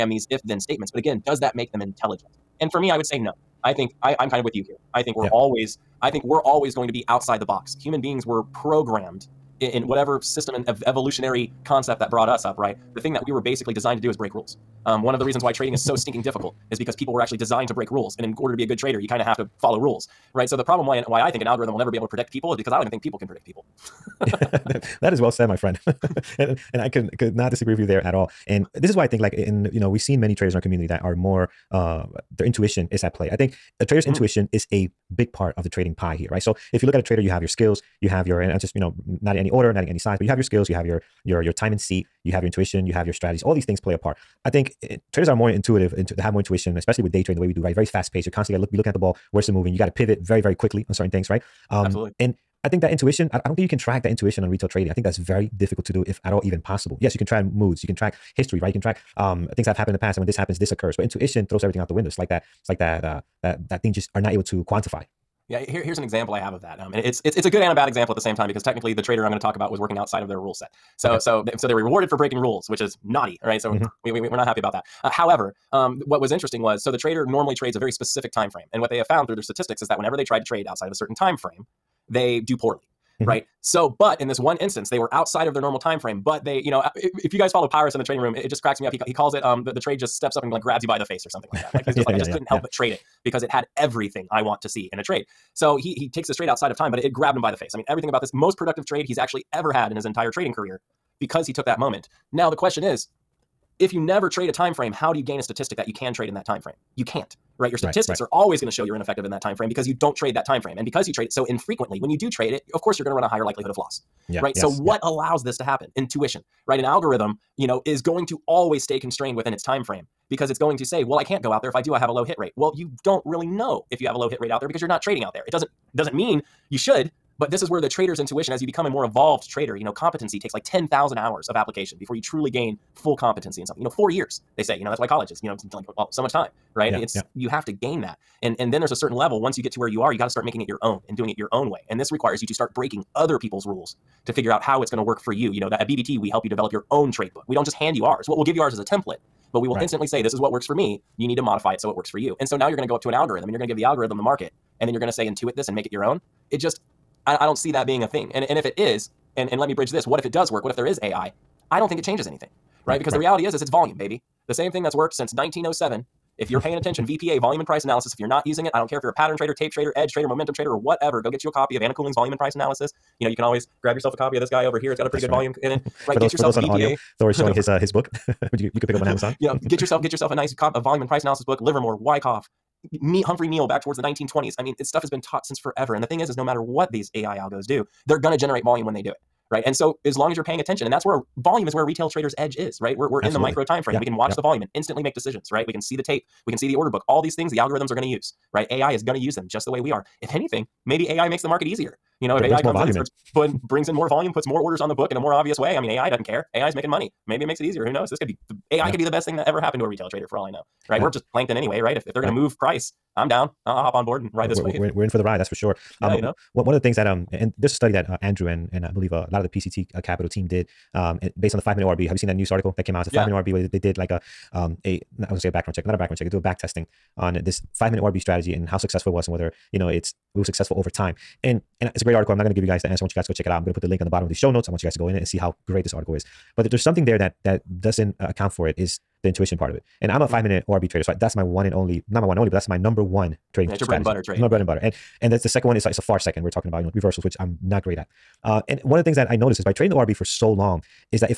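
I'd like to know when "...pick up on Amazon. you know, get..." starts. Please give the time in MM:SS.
02:58.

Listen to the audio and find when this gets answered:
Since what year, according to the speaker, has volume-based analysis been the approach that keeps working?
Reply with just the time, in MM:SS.
02:45.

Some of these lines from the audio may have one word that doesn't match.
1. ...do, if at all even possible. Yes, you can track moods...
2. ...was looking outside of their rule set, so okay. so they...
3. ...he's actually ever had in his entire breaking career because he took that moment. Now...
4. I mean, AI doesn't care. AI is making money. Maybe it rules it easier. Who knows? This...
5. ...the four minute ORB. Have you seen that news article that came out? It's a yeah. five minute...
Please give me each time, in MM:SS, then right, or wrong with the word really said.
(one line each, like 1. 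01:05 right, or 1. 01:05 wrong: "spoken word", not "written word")
1. 00:55 right
2. 01:09 wrong: "working", not "looking"
3. 01:39 wrong: "trading", not "breaking"
4. 03:25 wrong: "makes", not "rules"
5. 03:41 wrong: "five", not "four".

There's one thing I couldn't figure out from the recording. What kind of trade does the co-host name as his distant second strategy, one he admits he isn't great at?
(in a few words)
Reversals.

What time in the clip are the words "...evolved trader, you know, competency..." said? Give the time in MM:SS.
02:09.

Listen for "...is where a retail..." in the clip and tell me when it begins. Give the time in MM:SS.
03:11.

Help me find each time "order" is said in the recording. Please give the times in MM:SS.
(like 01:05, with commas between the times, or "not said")
00:18, 00:39, 03:16, 03:24.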